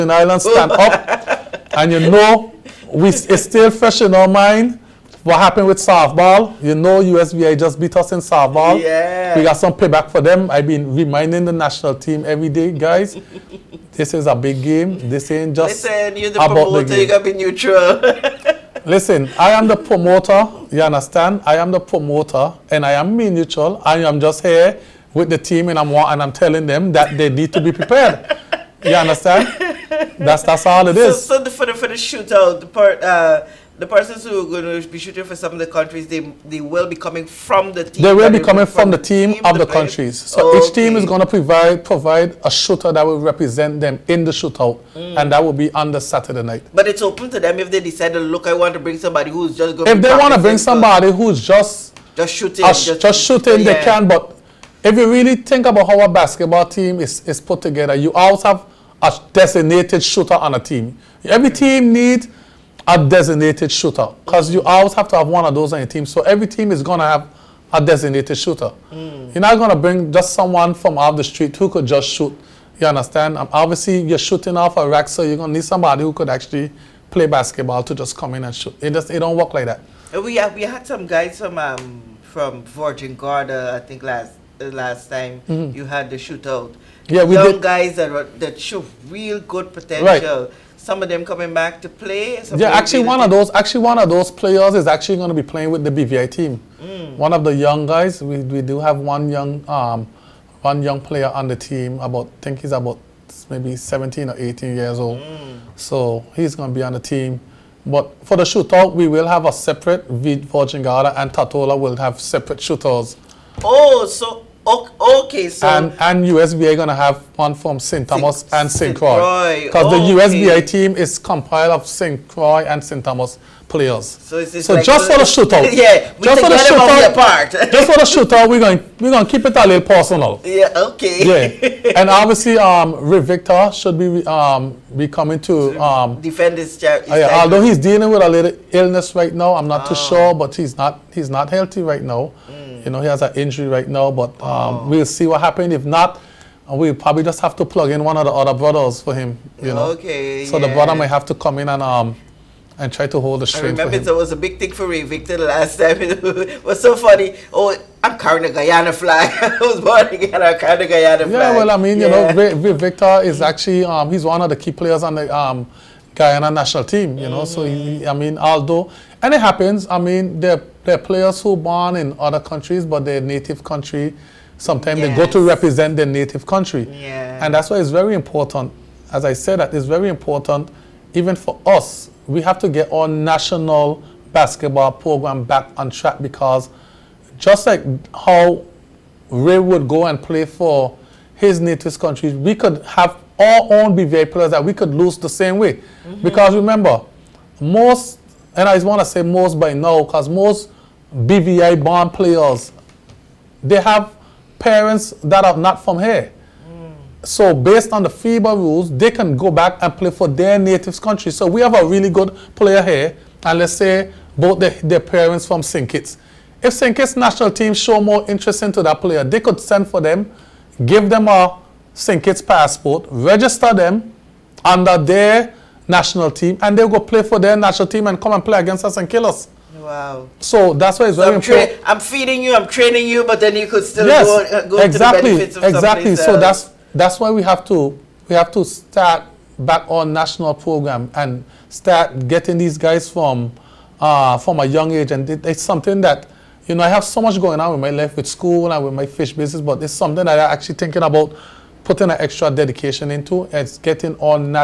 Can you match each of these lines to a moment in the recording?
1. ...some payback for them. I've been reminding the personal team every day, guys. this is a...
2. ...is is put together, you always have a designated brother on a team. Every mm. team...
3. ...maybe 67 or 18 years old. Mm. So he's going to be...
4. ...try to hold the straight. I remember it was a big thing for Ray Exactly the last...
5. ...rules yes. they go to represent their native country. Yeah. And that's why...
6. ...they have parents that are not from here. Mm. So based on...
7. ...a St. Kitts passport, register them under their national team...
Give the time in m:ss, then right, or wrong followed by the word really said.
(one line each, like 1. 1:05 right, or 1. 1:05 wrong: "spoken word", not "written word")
1. 0:09 wrong: "national", not "personal"
2. 0:57 wrong: "shooter", not "brother"
3. 1:43 wrong: "17", not "67"
4. 2:32 wrong: "Victor", not "Exactly"
5. 2:54 wrong: "sometimes", not "rules"
6. 3:23 right
7. 3:41 right.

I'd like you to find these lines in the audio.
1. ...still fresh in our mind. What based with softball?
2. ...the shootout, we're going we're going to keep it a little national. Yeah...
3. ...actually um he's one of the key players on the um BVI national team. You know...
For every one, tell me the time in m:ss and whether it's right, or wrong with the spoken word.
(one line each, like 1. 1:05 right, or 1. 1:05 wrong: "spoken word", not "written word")
1. 0:03 wrong: "happened", not "based"
2. 2:07 wrong: "personal", not "national"
3. 2:43 wrong: "Guyana", not "BVI".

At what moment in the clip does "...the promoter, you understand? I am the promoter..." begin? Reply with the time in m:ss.
0:19.